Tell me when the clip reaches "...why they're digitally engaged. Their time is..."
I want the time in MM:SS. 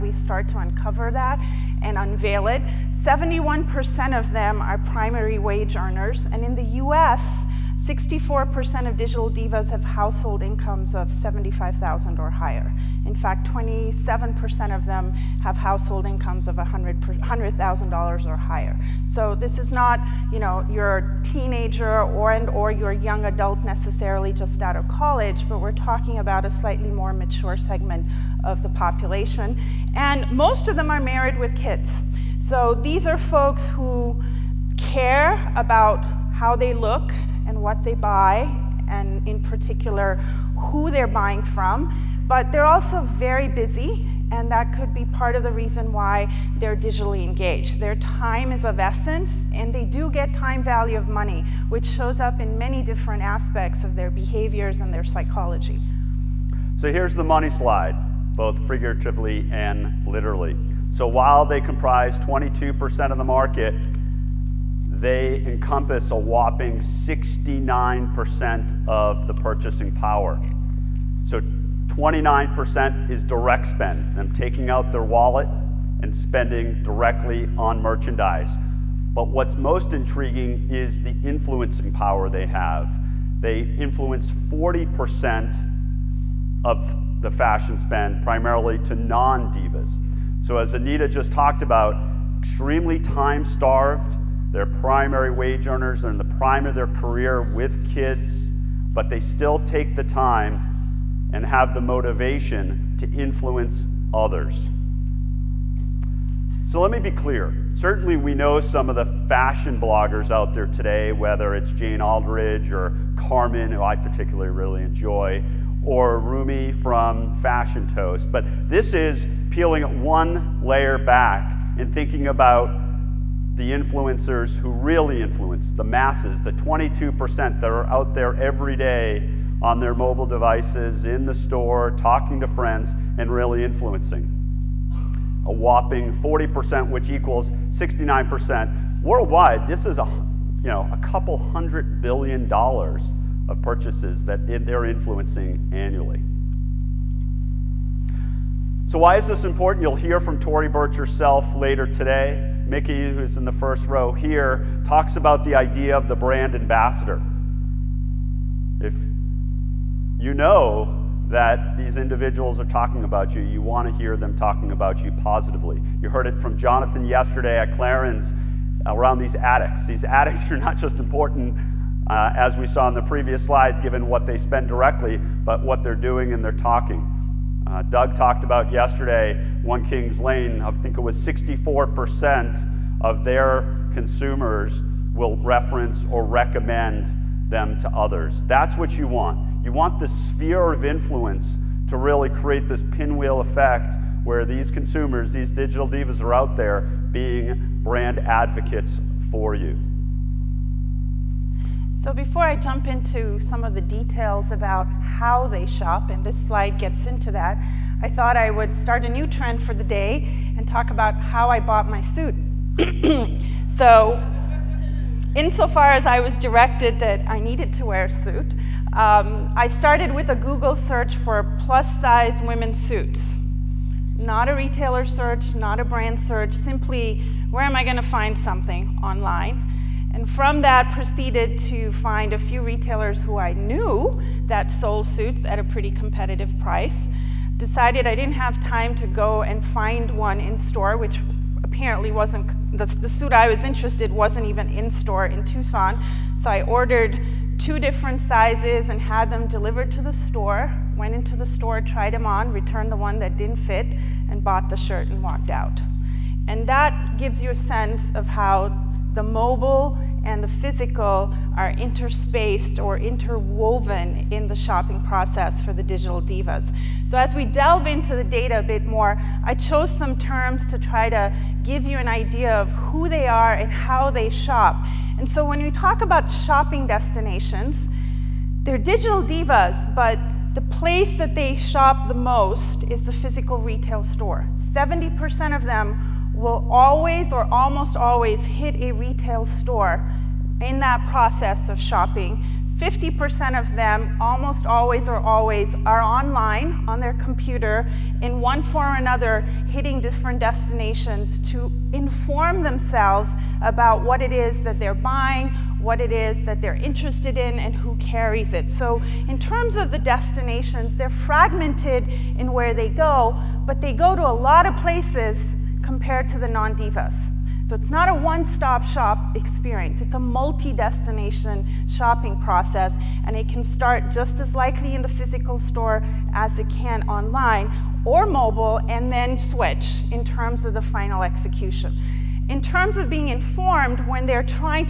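00:45.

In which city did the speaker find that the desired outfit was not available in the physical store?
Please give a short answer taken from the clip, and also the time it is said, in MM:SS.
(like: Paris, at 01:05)
Tucson, at 04:05.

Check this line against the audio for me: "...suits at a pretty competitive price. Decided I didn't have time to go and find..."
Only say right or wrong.
right.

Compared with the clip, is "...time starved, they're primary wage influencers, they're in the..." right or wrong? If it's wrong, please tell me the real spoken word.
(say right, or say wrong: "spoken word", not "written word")
wrong: "earners", not "influencers".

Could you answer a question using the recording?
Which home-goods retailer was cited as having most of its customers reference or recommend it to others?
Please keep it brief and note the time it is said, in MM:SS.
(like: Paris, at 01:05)
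One Kings Lane, at 02:59.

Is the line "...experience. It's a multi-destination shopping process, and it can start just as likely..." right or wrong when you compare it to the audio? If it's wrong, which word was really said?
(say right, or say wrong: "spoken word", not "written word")
right.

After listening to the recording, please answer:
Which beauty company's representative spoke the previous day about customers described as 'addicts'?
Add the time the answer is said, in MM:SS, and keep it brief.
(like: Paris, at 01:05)
Clarins, at 02:47.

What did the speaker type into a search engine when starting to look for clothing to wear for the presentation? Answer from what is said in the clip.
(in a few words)
plus-size women's suits.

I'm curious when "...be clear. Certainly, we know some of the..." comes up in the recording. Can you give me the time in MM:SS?
01:46.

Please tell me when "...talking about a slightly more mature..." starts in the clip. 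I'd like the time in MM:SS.
00:25.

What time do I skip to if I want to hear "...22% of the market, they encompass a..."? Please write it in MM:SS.
01:02.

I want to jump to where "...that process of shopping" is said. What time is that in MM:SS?
04:50.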